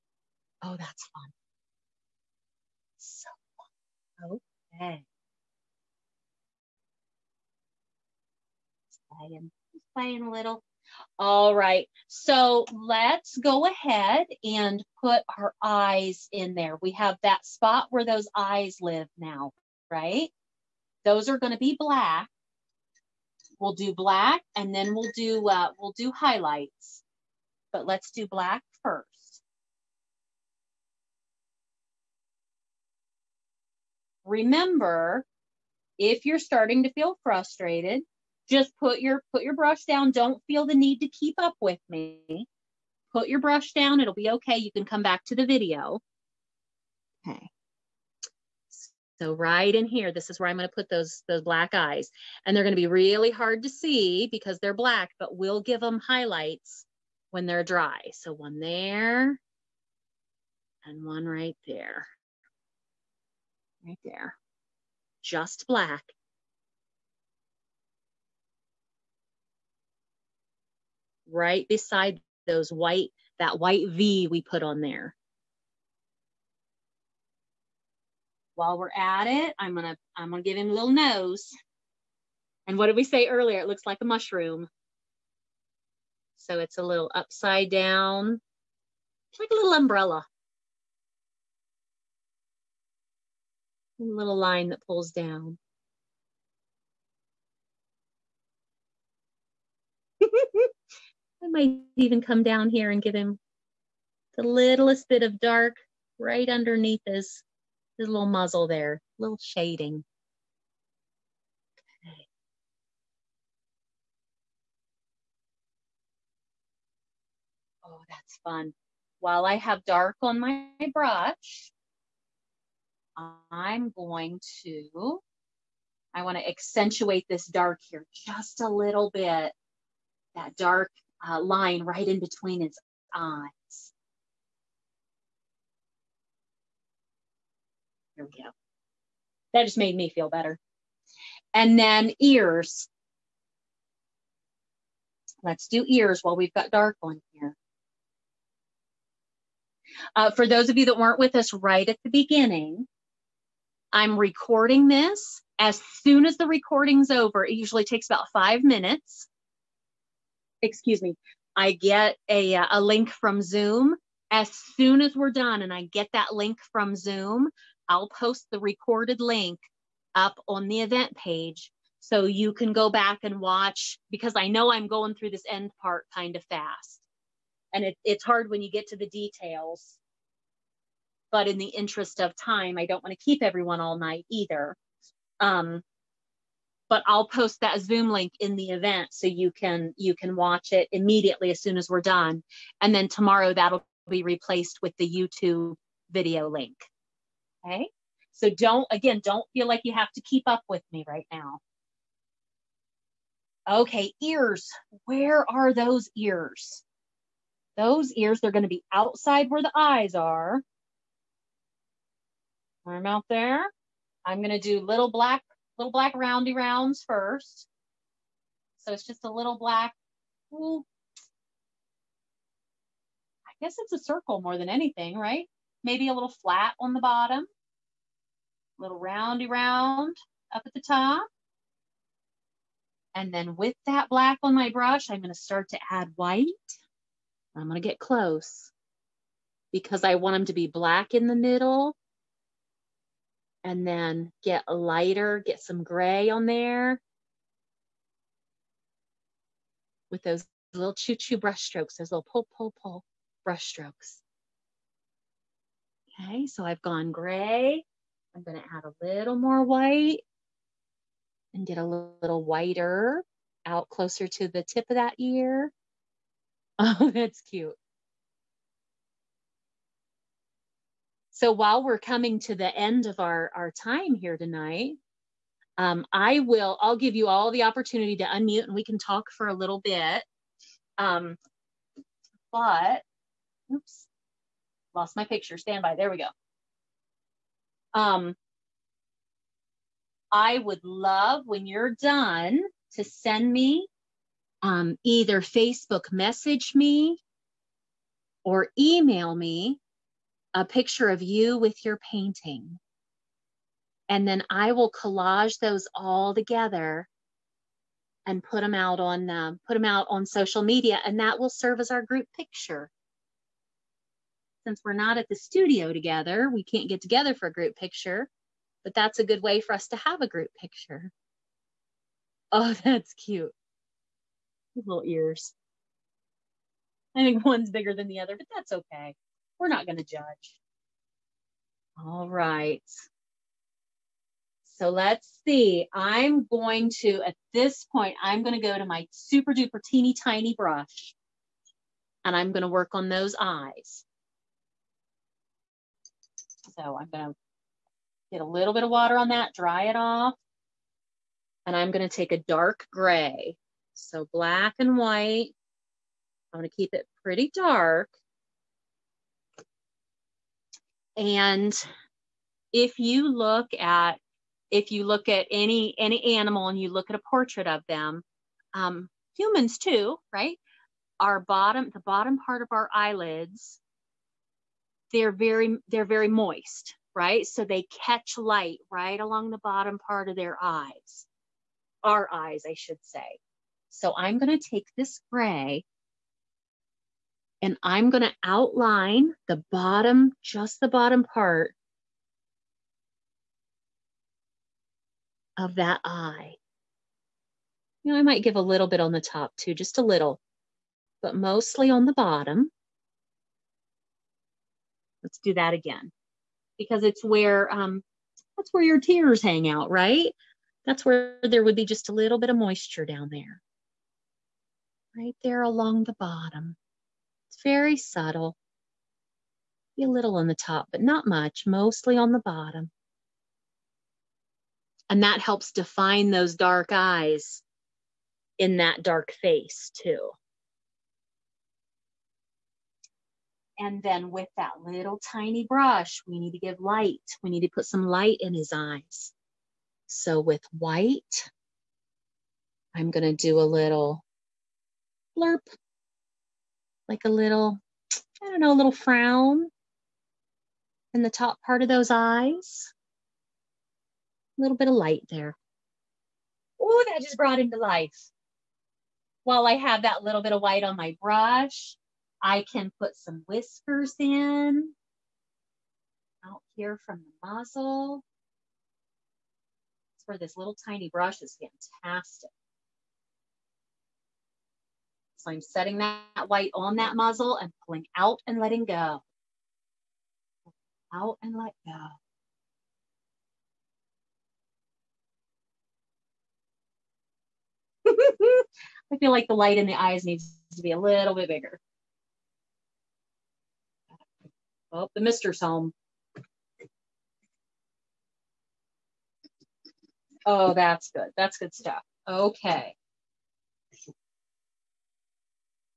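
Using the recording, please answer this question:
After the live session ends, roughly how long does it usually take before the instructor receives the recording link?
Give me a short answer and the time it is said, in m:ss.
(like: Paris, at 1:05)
About five minutes, at 2:38.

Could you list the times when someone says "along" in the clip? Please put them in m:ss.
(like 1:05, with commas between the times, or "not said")
6:19, 6:55.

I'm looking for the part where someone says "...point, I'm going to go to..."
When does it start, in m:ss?
5:37.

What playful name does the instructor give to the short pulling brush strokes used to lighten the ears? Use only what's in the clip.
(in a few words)
Choo-choo brush strokes.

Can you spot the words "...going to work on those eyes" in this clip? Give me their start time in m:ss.
5:42.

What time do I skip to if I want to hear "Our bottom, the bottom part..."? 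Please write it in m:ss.
6:11.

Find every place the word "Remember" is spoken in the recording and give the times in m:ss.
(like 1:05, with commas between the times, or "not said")
0:34.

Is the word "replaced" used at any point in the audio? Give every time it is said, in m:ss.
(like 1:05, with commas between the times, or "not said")
3:14.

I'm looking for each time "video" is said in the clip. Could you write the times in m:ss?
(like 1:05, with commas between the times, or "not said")
0:45, 3:16.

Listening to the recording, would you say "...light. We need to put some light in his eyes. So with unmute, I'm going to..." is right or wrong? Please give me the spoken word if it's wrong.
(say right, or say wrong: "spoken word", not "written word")
wrong: "white", not "unmute".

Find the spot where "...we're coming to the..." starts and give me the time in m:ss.
4:31.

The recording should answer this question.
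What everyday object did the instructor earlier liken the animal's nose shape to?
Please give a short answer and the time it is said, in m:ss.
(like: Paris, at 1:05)
Mushroom, at 1:24.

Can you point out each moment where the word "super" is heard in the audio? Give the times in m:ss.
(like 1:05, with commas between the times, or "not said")
5:39.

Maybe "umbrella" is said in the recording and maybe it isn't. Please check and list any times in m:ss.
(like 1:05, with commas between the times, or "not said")
1:29.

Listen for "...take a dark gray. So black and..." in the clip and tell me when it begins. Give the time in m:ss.
5:52.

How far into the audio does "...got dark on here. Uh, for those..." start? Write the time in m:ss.
2:26.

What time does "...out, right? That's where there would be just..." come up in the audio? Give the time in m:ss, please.
6:49.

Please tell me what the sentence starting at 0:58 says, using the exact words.
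So one there and one right there.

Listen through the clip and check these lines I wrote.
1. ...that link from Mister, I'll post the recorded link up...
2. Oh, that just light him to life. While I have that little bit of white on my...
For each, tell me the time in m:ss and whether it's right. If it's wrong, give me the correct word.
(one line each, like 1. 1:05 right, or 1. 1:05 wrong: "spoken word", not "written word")
1. 2:46 wrong: "Zoom", not "Mister"
2. 7:36 wrong: "brought", not "light".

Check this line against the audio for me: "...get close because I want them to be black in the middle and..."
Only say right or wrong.
right.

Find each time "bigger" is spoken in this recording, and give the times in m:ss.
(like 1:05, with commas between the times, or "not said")
5:27, 8:11.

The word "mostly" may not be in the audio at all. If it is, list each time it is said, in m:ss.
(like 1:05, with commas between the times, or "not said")
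6:41, 7:01.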